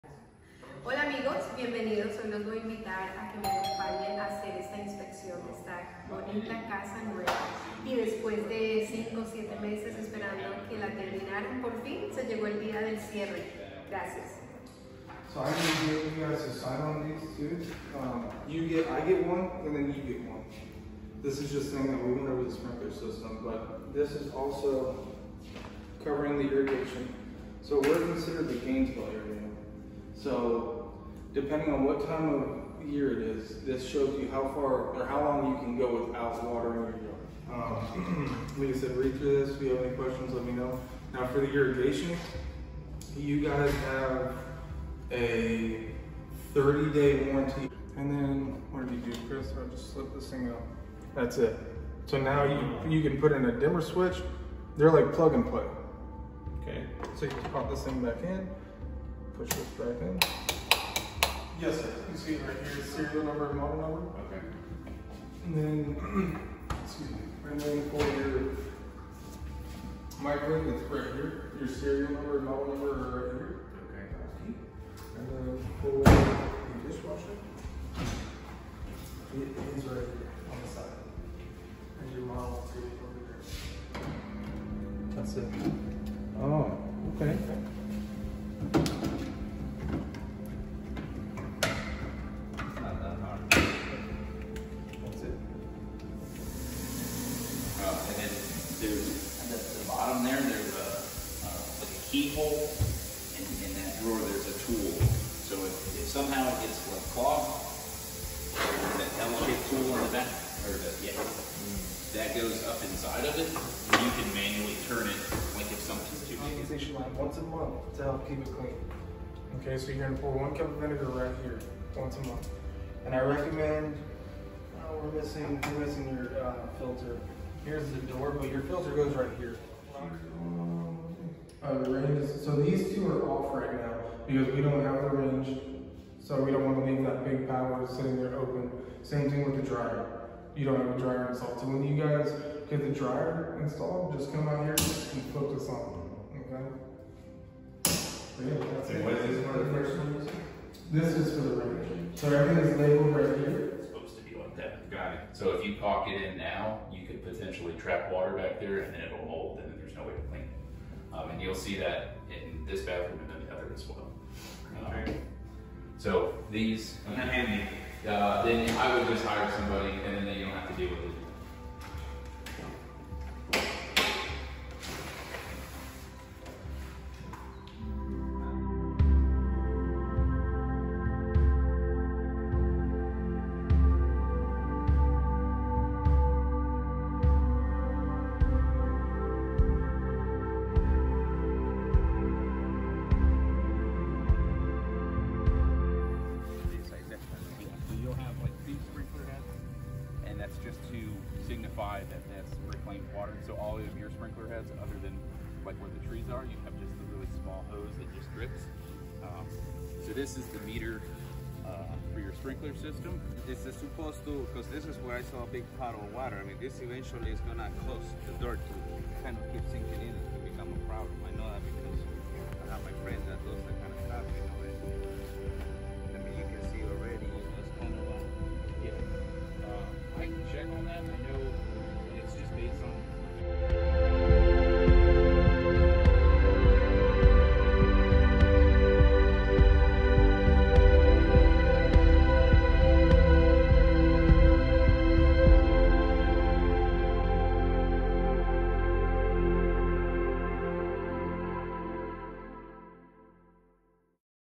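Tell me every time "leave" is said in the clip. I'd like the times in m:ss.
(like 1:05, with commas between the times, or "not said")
2:16.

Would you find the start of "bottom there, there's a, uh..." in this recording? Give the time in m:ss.
1:40.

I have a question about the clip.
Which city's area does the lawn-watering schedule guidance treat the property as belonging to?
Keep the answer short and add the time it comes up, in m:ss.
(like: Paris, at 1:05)
Gainesville, at 0:28.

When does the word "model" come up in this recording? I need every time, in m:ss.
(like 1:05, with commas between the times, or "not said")
1:03, 1:12, 1:22.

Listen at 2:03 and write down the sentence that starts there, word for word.
And I recommend, oh, we're missing, we're missing your uh, filter.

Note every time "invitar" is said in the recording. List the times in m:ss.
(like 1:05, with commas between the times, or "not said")
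0:02.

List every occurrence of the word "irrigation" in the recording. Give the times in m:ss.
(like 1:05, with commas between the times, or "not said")
0:26, 0:41.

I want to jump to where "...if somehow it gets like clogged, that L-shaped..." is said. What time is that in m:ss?
1:46.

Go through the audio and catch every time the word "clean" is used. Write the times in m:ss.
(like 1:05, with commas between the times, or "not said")
1:58, 2:40.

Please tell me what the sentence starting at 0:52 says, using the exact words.
So now you, you can put in a dimmer switch.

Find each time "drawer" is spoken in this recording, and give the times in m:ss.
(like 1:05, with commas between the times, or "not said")
1:44.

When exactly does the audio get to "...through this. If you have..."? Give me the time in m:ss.
0:39.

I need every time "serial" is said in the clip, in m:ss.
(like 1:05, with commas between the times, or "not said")
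1:02, 1:11.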